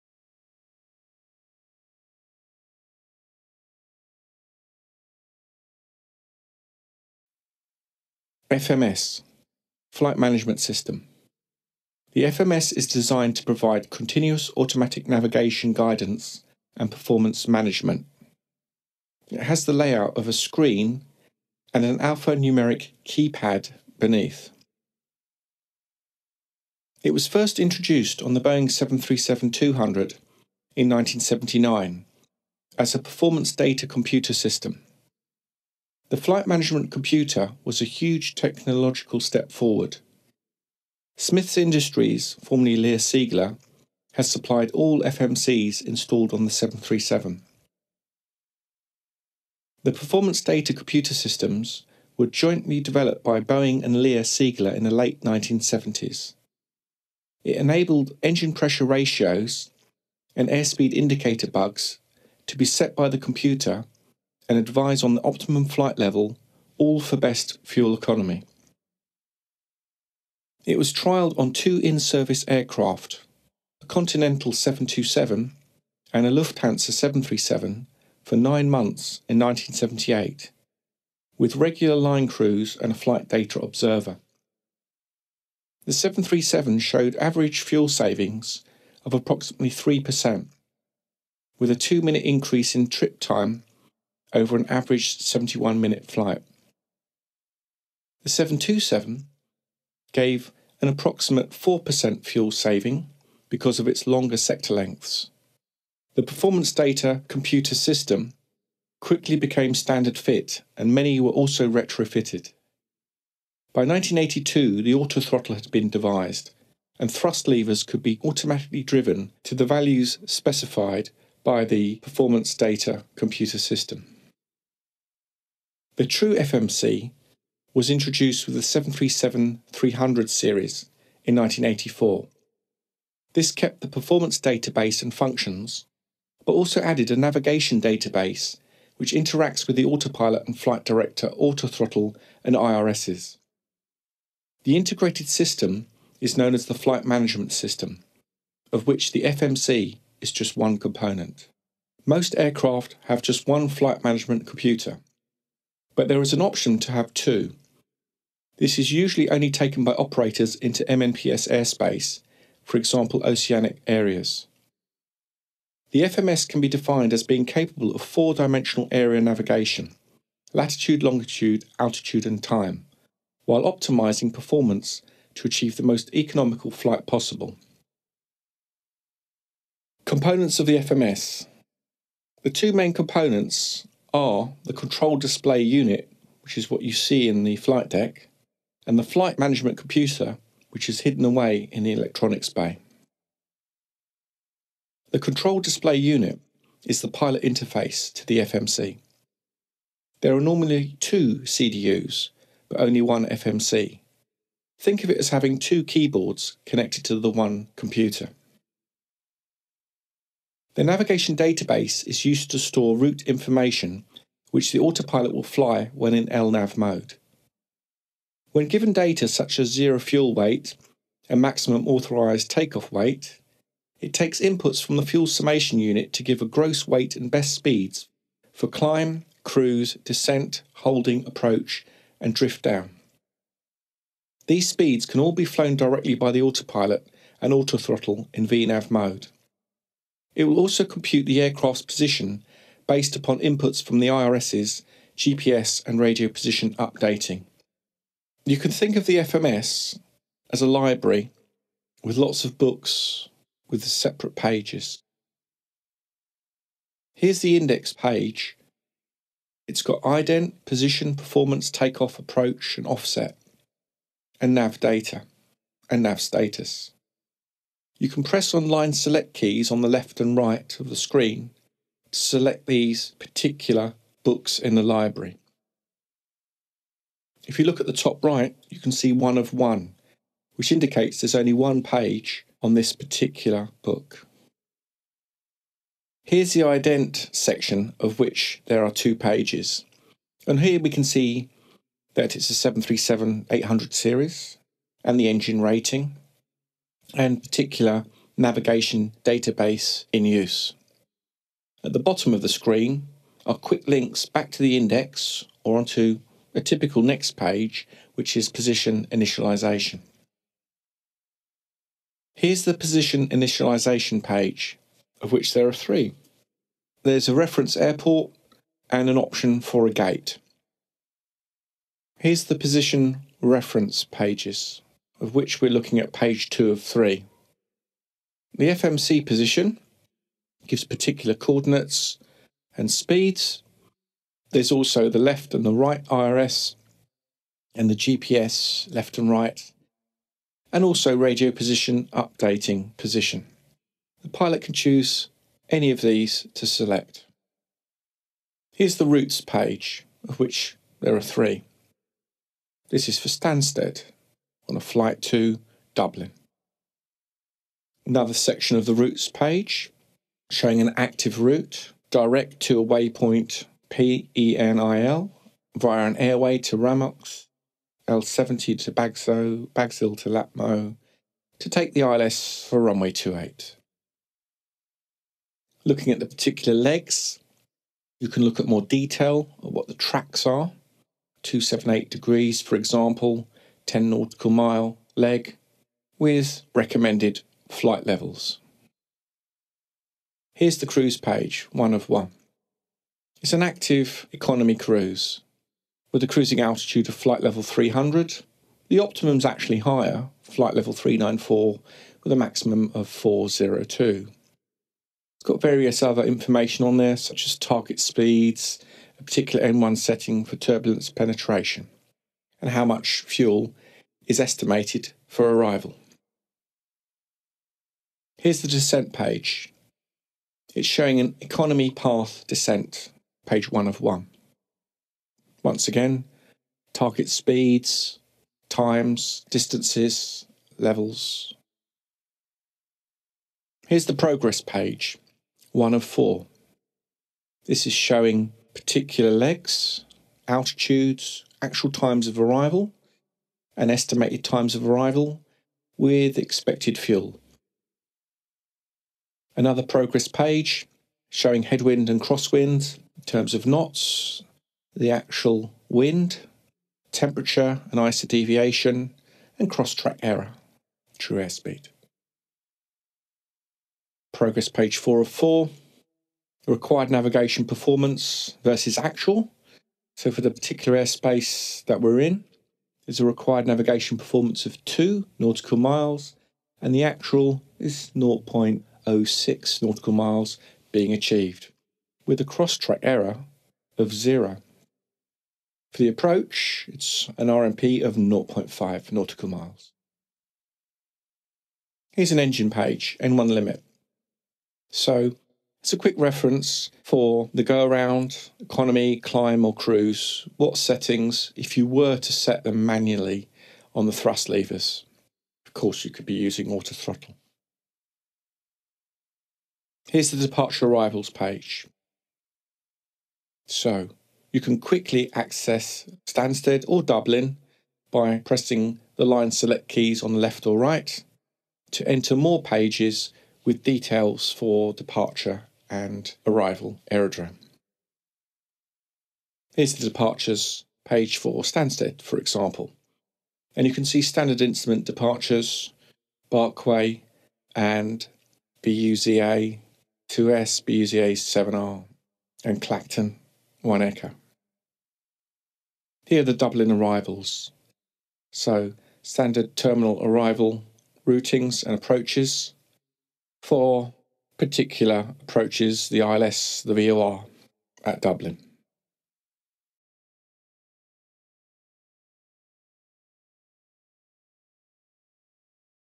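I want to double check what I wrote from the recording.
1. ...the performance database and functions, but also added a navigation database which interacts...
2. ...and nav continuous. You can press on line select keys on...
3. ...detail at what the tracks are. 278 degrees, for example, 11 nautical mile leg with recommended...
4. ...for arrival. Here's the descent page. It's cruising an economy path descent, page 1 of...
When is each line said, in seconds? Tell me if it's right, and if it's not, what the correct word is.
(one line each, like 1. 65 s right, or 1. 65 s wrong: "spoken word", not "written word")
1. 133 s right
2. 265 s wrong: "status", not "continuous"
3. 378 s wrong: "10", not "11"
4. 415 s wrong: "showing", not "cruising".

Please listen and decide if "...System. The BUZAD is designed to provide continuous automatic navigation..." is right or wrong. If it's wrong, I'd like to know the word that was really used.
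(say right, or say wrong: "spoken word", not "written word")
wrong: "FMS", not "BUZAD".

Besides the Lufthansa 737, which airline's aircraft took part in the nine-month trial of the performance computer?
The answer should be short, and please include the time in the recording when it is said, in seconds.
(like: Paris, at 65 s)
Continental, at 73 s.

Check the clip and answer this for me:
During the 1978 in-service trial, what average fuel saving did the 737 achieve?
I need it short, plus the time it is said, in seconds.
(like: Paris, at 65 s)
approximately 3%, at 89 s.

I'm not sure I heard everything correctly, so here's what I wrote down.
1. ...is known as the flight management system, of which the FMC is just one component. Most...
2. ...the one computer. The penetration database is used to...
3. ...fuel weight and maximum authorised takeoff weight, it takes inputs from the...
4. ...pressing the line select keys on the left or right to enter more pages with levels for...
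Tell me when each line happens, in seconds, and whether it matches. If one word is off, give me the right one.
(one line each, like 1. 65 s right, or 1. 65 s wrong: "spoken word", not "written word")
1. 146 s right
2. 207 s wrong: "navigation", not "penetration"
3. 219 s right
4. 518 s wrong: "details", not "levels".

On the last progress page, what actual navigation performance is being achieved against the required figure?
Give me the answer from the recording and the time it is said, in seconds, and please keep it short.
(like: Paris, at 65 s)
0.06 nautical miles, at 478 s.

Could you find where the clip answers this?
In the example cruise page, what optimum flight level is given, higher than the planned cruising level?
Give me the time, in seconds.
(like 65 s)
400 s.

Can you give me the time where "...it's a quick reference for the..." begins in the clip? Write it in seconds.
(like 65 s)
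495 s.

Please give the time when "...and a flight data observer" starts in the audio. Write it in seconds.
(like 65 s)
82 s.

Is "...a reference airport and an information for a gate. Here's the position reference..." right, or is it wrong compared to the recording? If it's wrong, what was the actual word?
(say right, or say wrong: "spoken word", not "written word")
wrong: "option", not "information".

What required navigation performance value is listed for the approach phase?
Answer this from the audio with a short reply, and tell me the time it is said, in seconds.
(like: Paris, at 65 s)
0.5 nautical miles, at 488 s.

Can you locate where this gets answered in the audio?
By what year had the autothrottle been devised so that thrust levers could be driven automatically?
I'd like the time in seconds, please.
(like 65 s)
113 s.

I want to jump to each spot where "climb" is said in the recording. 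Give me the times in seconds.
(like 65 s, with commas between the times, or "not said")
228 s, 499 s.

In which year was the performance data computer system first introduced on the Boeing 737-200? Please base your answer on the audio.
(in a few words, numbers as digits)
1979.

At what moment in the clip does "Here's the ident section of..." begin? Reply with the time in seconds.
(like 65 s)
286 s.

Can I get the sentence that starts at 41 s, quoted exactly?
Smith's Industries, formerly Lear Siegler, has supplied all FMCs installed on the 737.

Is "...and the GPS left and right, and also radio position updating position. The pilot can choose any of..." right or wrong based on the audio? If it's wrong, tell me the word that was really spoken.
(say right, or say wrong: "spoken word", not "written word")
right.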